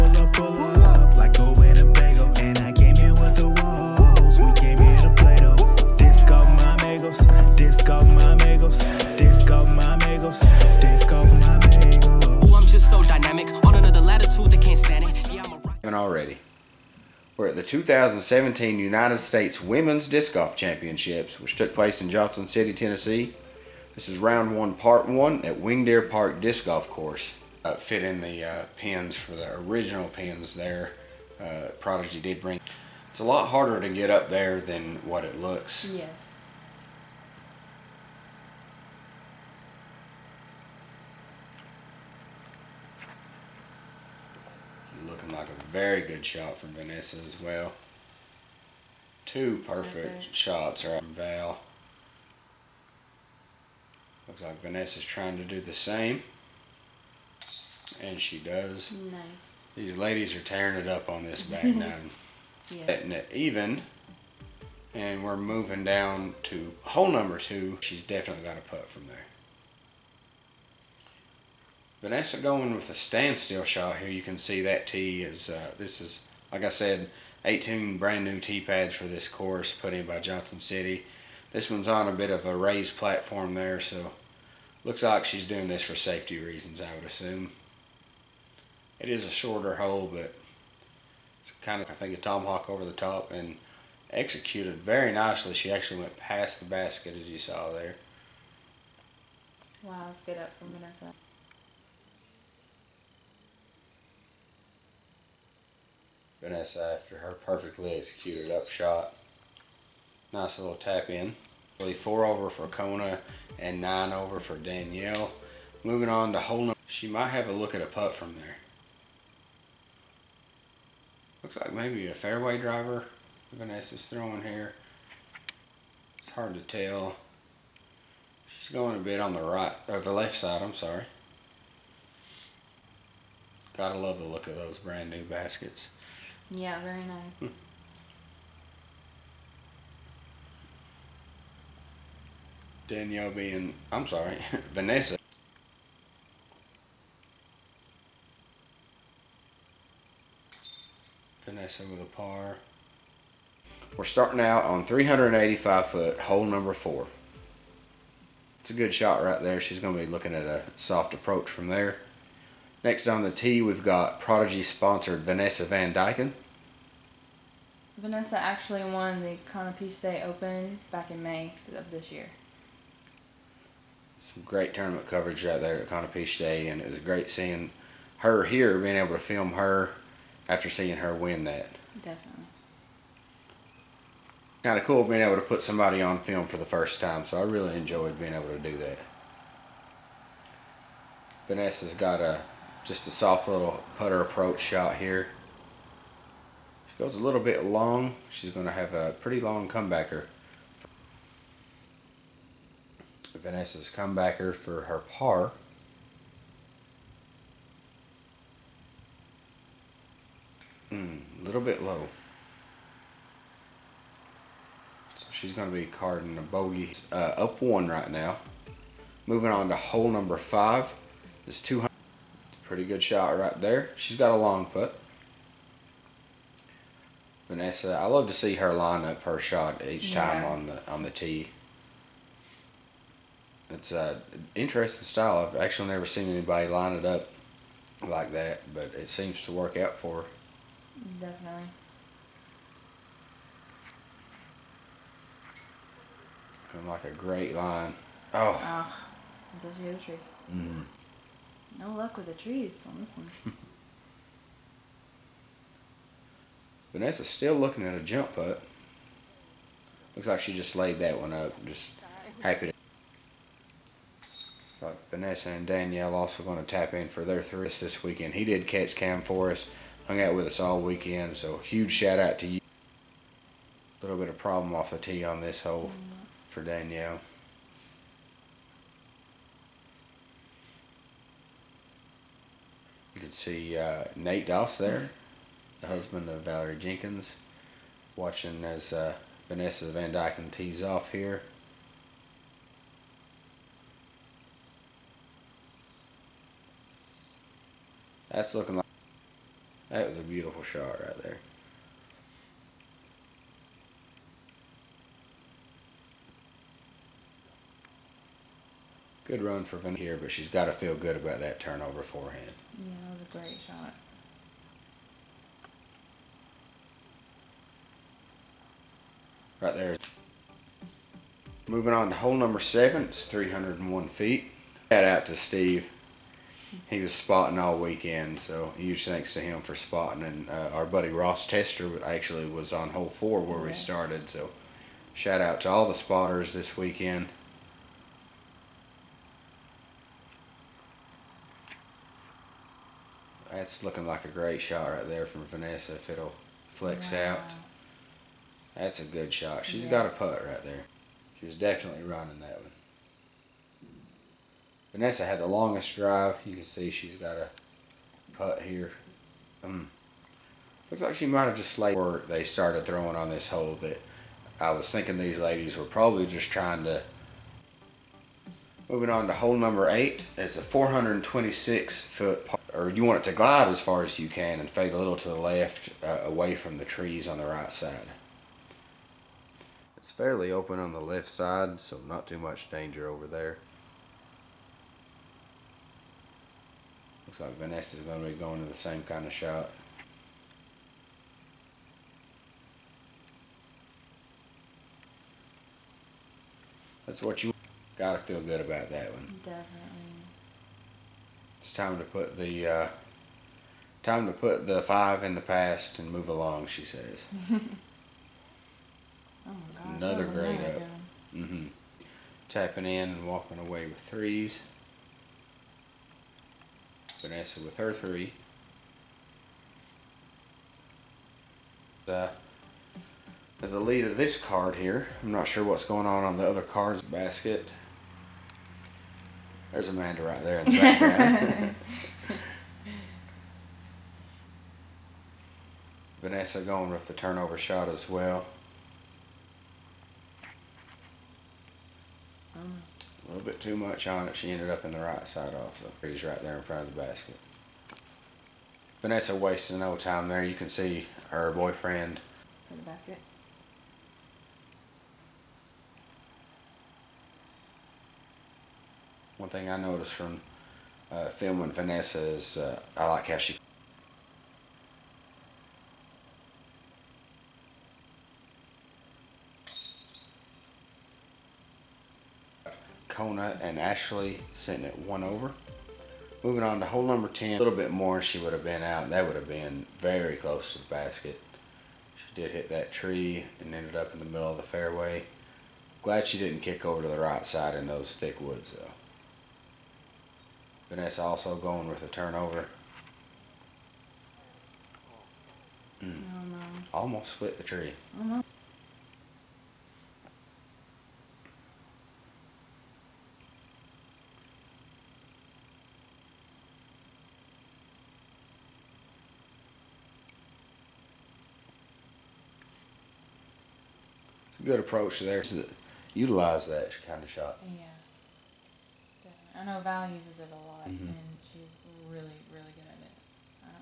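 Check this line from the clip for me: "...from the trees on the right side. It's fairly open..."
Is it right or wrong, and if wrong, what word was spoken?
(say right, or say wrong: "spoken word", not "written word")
right.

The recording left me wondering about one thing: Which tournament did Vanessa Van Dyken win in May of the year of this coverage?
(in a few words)
Conopy Day Open.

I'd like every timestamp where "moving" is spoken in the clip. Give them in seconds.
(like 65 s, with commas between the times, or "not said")
65 s, 115 s, 219 s, 321 s, 368 s, 476 s.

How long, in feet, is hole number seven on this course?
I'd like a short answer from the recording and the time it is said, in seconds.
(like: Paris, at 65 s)
301 feet, at 323 s.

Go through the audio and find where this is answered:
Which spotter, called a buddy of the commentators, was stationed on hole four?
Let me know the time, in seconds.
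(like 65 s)
331 s.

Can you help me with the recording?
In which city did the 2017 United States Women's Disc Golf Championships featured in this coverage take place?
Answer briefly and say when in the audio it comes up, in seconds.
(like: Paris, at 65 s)
Johnson City, Tennessee, at 22 s.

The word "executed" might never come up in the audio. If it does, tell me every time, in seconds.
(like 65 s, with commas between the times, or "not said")
94 s, 107 s.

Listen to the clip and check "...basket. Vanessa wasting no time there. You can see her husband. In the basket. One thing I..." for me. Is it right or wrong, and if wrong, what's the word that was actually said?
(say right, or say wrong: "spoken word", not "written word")
wrong: "boyfriend", not "husband".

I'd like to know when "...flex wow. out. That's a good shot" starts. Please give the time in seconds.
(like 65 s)
346 s.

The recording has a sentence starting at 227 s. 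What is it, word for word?
Vanessa, I love to see her line up her shot each time yeah.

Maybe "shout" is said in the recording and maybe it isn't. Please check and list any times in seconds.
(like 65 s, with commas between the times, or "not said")
271 s, 324 s, 335 s.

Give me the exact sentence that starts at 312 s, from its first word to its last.
Yeah, that was a great shot.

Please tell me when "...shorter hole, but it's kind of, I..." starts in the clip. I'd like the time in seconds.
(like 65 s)
89 s.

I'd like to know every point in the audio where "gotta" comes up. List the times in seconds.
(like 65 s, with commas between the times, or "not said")
133 s, 397 s.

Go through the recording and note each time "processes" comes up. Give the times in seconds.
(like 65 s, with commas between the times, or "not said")
not said.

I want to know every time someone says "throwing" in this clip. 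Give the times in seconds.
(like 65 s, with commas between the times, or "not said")
124 s, 362 s.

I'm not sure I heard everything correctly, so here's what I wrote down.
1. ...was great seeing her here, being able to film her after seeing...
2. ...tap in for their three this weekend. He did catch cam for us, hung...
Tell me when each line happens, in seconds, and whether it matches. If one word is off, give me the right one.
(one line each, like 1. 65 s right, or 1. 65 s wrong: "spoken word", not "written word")
1. 176 s right
2. 266 s right.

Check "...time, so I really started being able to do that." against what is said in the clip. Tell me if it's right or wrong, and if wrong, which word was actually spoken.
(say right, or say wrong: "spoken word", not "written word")
wrong: "enjoyed", not "started".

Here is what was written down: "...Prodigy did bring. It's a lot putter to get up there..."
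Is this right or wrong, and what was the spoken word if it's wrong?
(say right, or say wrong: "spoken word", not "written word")
wrong: "harder", not "putter".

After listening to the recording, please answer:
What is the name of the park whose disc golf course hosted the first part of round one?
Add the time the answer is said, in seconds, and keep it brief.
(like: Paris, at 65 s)
Winged Deer Park, at 25 s.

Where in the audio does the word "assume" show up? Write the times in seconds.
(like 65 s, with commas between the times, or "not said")
87 s.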